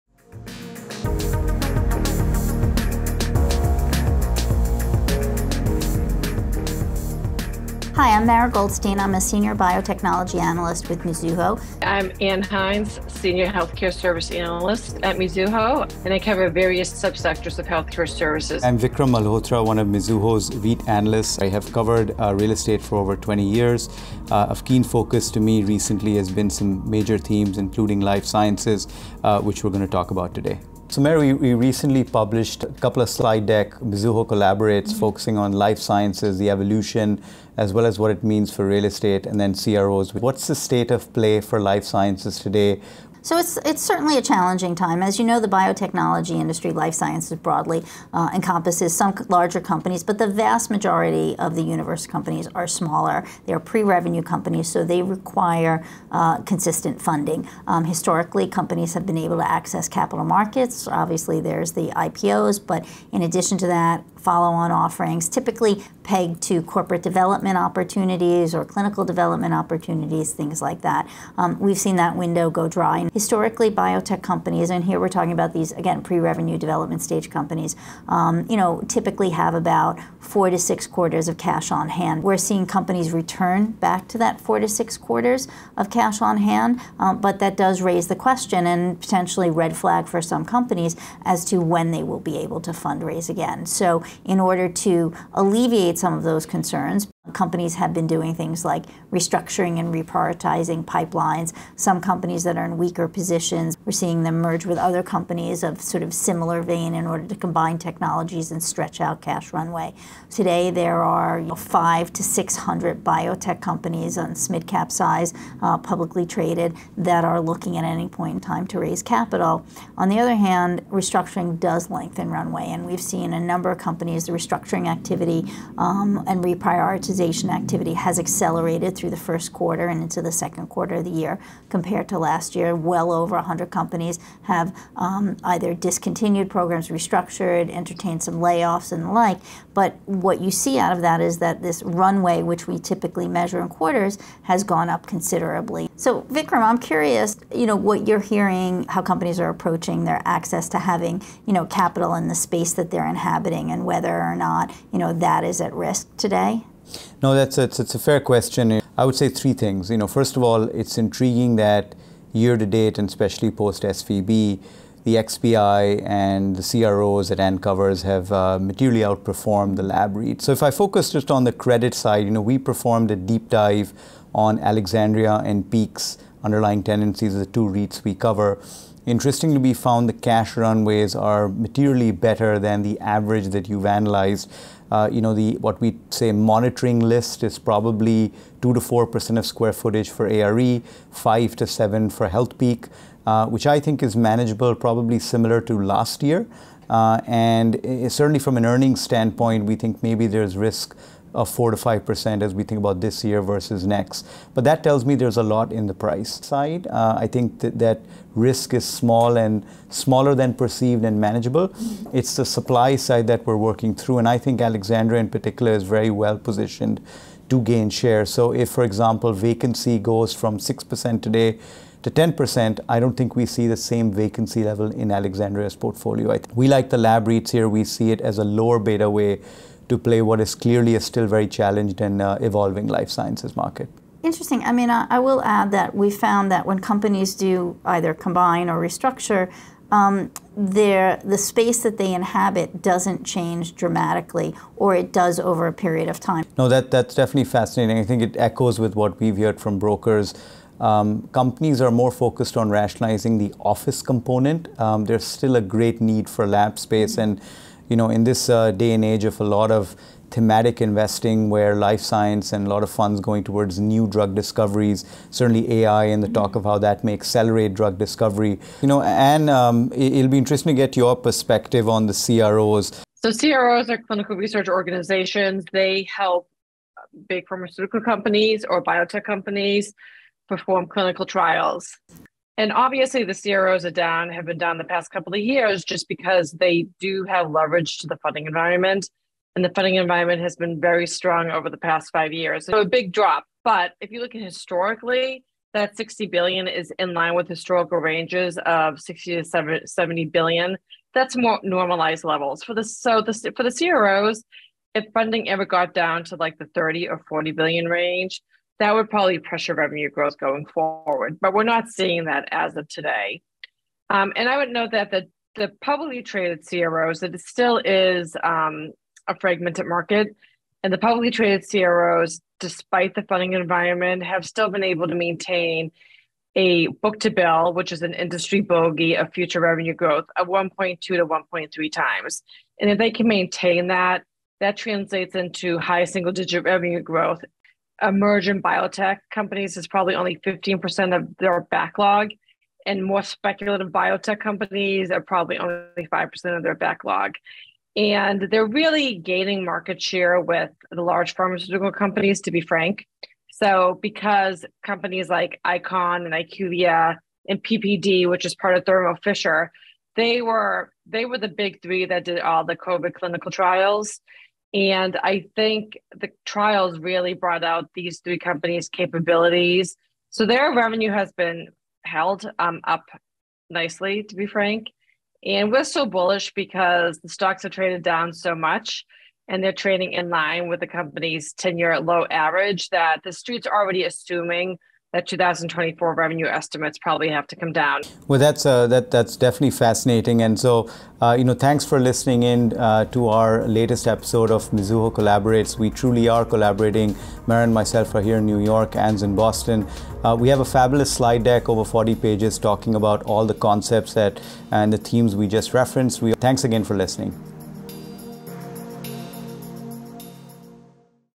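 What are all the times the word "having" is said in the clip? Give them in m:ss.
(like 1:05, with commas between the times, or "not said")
2:30.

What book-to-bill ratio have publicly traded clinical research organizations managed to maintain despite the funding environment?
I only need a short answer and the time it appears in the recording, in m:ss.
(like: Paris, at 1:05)
1.2 to 1.3 times, at 5:30.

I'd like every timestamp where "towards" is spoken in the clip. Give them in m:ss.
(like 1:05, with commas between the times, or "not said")
4:23.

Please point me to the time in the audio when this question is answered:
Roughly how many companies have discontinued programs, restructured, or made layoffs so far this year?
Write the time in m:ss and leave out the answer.
2:12.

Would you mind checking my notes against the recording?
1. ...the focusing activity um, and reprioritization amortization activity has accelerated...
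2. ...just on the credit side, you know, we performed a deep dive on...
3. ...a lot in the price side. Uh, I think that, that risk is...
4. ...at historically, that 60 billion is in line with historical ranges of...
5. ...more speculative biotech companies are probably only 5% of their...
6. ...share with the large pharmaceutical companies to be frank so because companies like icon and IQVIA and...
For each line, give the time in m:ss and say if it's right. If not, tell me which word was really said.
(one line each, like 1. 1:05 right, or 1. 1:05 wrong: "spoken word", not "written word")
1. 2:04 wrong: "restructuring", not "focusing"
2. 2:51 right
3. 3:25 right
4. 4:54 right
5. 5:43 right
6. 5:50 right.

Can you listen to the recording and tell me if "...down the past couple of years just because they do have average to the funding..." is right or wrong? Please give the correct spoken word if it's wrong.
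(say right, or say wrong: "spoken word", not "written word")
wrong: "leverage", not "average".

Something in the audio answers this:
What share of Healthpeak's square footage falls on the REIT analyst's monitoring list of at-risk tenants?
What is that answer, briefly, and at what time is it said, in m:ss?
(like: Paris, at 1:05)
5 to 7 percent, at 3:11.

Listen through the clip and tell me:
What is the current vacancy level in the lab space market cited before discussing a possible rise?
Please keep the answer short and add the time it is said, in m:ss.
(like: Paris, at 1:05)
6%, at 3:40.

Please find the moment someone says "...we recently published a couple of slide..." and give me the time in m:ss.
0:31.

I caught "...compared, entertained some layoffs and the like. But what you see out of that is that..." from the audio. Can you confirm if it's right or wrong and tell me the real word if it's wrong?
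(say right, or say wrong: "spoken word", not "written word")
wrong: "restructured", not "compared".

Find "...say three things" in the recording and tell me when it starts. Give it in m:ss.
2:39.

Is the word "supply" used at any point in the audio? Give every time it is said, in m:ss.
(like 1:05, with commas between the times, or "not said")
3:32.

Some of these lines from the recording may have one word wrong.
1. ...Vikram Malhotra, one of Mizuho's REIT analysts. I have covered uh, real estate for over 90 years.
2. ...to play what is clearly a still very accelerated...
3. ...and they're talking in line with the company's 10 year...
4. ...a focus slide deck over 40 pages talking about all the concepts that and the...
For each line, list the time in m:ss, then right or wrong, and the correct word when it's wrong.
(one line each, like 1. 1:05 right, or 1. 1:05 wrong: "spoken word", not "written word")
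1. 0:18 wrong: "20", not "90"
2. 3:49 wrong: "challenged", not "accelerated"
3. 6:19 wrong: "trading", not "talking"
4. 6:40 wrong: "fabulous", not "focus".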